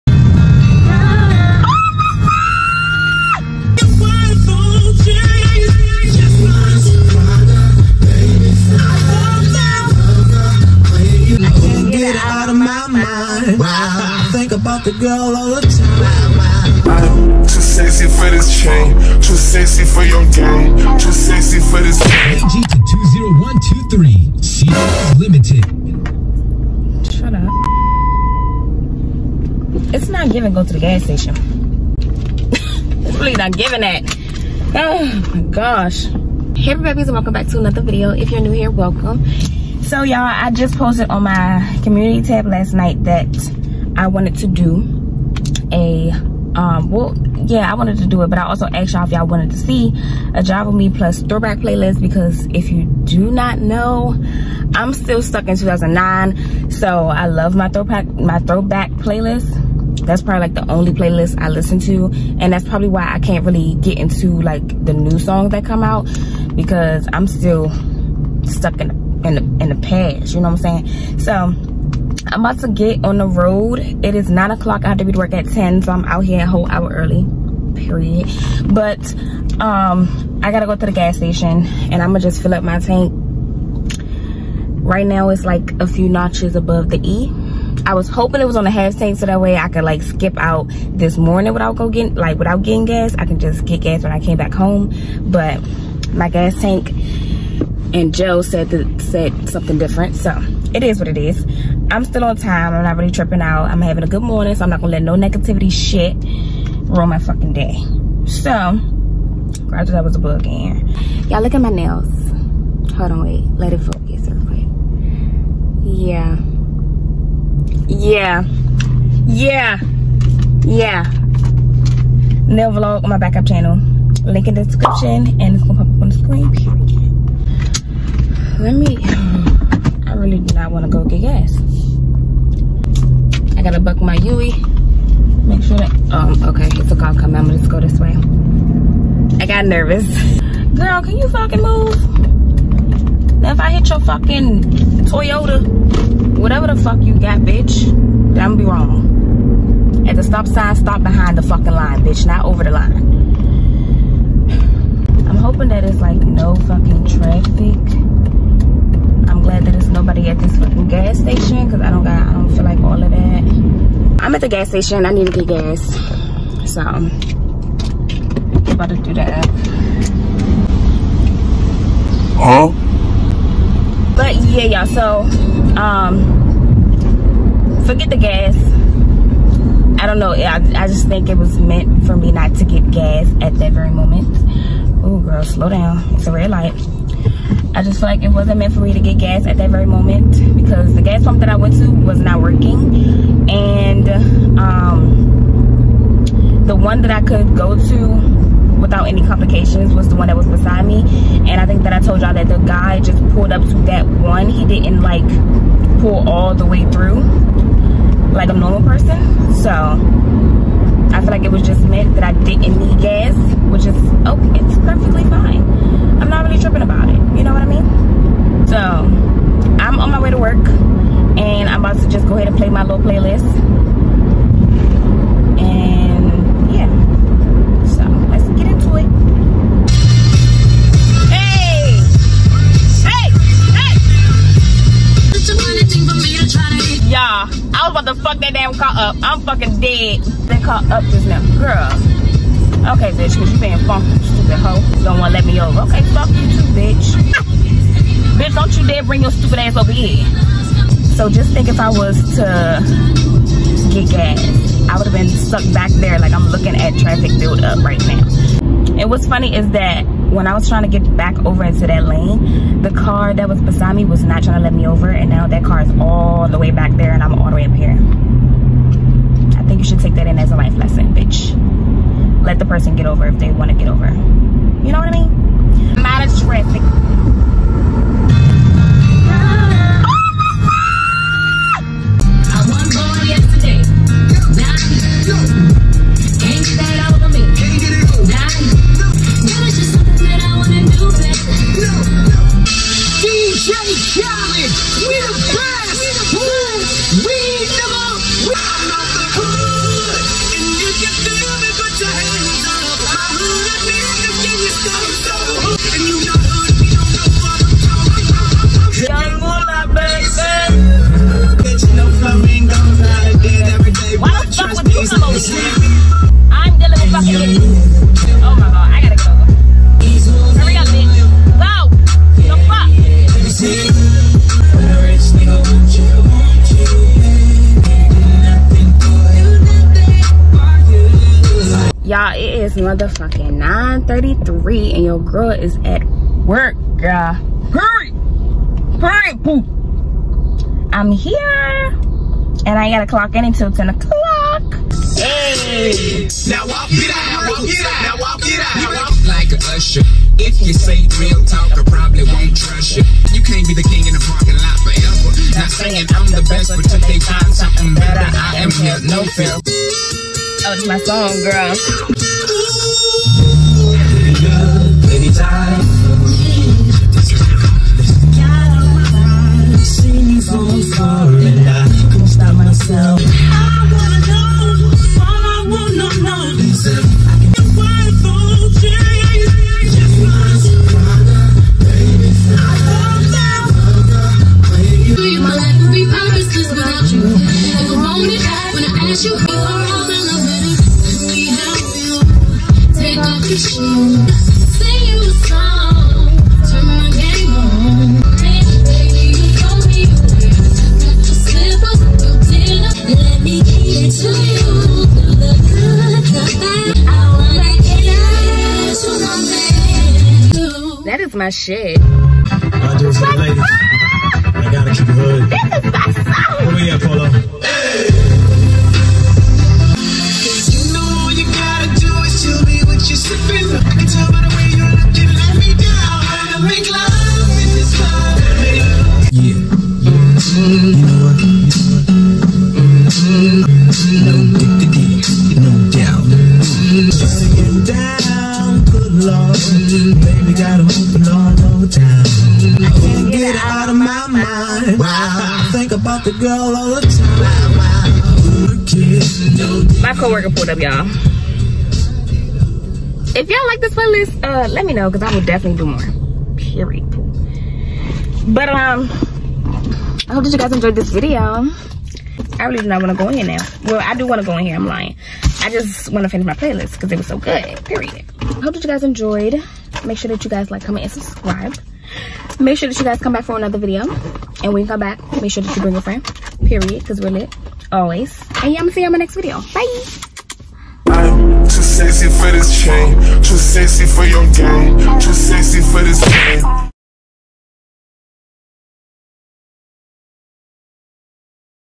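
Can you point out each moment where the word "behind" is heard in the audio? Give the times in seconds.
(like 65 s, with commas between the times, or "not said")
151 s.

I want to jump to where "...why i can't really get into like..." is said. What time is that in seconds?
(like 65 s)
62 s.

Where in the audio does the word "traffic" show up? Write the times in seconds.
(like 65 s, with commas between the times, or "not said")
256 s.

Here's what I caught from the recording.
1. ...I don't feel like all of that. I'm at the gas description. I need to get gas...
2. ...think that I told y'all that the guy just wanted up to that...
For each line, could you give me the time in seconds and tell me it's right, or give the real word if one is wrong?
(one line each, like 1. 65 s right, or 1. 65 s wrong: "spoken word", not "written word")
1. 162 s wrong: "station", not "description"
2. 201 s wrong: "pulled", not "wanted".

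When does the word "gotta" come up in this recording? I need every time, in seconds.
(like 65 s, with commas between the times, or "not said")
80 s, 133 s, 342 s.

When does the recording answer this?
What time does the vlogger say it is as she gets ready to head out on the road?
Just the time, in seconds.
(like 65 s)
74 s.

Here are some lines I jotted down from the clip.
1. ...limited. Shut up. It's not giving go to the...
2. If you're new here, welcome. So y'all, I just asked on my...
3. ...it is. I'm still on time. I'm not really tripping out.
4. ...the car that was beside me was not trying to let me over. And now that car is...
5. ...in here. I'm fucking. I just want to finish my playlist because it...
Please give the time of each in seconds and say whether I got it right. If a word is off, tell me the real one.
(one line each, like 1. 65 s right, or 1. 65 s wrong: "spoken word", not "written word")
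1. 25 s right
2. 38 s wrong: "posted", not "asked"
3. 101 s right
4. 262 s right
5. 464 s wrong: "lying", not "fucking".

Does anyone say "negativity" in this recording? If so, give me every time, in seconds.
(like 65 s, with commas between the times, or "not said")
105 s.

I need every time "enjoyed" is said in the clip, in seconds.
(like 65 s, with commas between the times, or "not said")
460 s, 469 s.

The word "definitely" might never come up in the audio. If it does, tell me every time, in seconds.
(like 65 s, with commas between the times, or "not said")
455 s.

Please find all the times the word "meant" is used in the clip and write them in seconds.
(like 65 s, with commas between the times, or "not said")
181 s, 188 s, 211 s.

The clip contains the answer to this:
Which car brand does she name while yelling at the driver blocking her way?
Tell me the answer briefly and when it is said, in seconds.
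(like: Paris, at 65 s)
Toyota, at 145 s.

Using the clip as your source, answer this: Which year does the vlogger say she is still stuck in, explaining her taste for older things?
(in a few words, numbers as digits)
2009.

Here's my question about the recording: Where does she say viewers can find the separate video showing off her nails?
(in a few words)
Backup channel.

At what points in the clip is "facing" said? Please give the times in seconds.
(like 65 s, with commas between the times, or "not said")
not said.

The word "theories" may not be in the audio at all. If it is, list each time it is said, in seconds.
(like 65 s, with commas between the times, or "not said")
not said.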